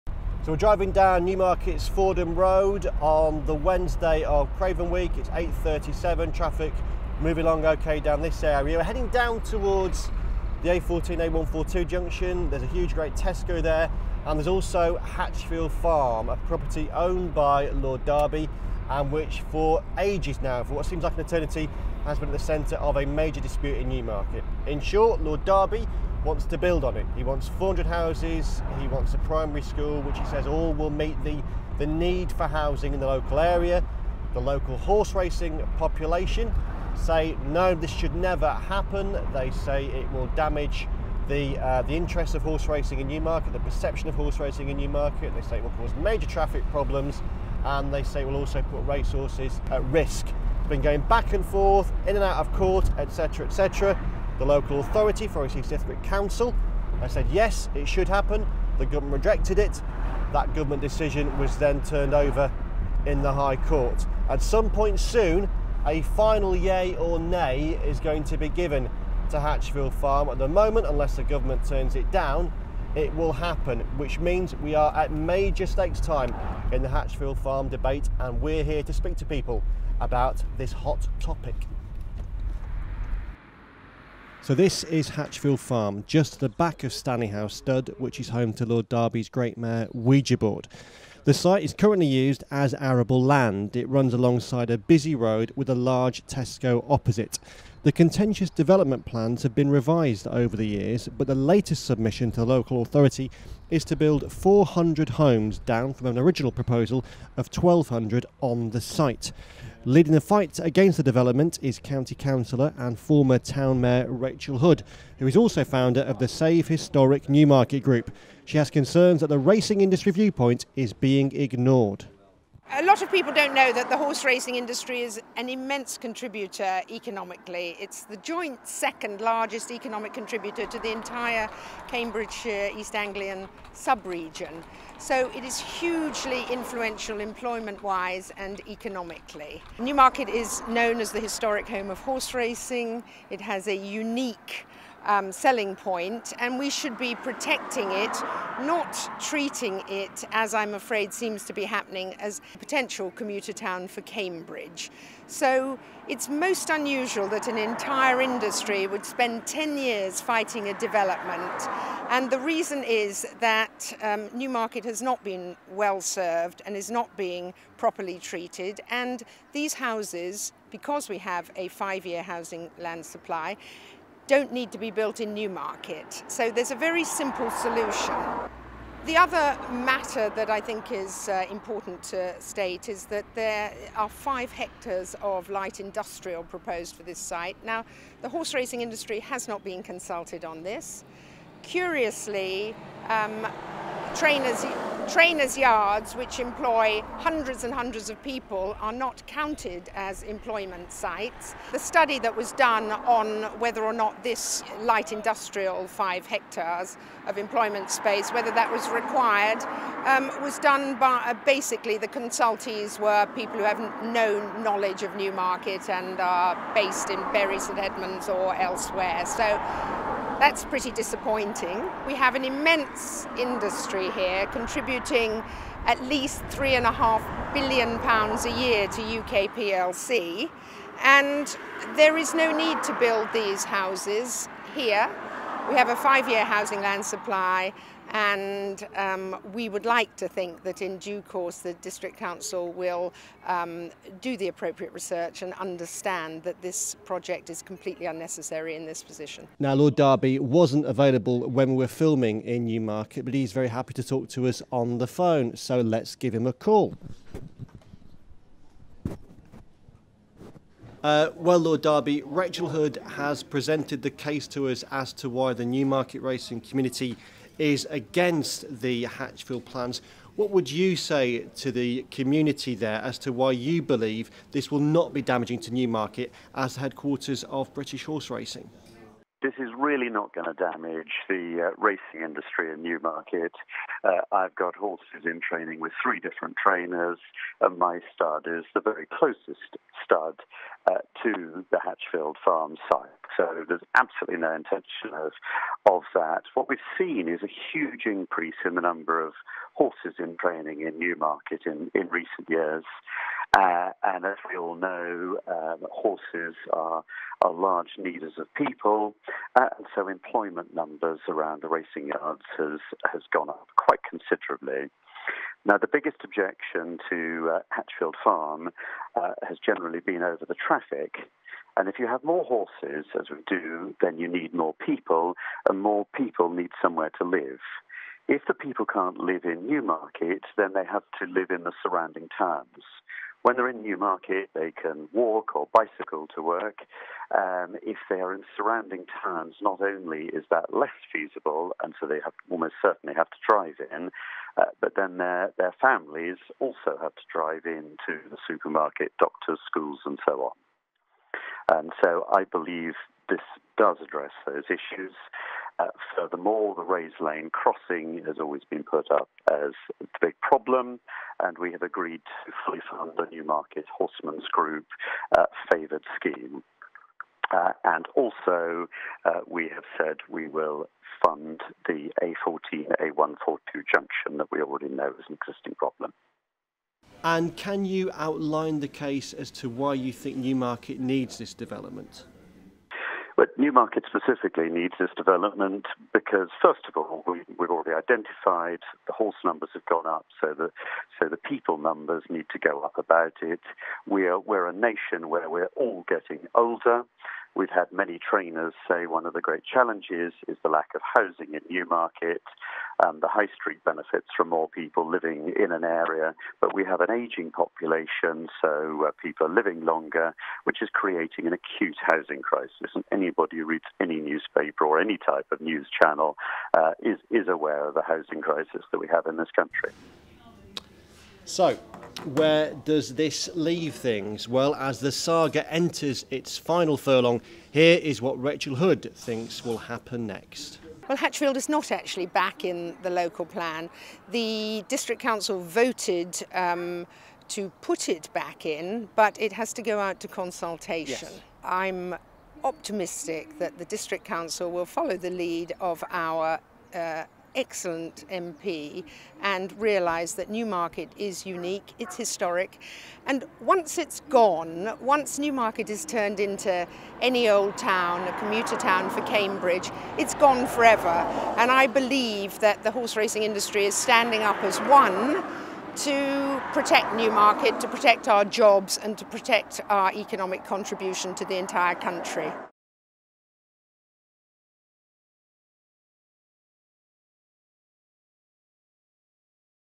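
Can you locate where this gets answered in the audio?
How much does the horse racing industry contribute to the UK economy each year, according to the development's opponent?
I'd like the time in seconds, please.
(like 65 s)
226 s.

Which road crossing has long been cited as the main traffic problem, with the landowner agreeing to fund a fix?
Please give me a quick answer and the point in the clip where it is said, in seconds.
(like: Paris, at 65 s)
Rayes Lane crossing, at 356 s.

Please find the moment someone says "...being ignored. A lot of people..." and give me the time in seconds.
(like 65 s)
120 s.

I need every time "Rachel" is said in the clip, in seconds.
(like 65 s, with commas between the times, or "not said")
114 s, 262 s, 428 s.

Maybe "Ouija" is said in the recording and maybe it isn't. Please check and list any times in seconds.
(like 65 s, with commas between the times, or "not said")
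89 s.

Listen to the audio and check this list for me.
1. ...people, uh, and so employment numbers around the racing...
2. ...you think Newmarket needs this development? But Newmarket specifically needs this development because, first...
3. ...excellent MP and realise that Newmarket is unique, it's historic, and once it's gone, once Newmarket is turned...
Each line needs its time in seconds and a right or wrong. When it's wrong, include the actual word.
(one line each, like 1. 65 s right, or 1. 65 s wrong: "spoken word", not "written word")
1. 308 s right
2. 379 s right
3. 447 s right.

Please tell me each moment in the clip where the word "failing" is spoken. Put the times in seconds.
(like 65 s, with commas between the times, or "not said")
not said.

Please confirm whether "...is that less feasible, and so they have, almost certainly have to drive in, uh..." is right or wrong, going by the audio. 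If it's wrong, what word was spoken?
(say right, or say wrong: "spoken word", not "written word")
right.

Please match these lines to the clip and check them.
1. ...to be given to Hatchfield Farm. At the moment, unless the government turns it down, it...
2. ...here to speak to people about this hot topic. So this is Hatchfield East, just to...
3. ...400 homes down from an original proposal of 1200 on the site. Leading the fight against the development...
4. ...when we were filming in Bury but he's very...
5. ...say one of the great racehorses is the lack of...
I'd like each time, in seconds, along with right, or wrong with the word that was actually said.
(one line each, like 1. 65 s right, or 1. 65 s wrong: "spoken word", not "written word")
1. 68 s right
2. 78 s wrong: "Farm", not "East"
3. 104 s right
4. 251 s wrong: "Newmarket", not "Bury"
5. 398 s wrong: "challenges", not "racehorses".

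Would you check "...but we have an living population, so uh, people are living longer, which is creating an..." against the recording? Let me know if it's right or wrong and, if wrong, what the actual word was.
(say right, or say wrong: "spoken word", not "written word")
wrong: "ageing", not "living".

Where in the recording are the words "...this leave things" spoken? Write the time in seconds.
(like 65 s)
423 s.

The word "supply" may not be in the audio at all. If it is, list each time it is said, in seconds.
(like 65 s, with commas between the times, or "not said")
173 s, 237 s.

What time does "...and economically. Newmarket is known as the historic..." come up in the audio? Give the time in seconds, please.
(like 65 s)
138 s.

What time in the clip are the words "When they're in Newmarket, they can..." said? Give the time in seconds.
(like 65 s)
333 s.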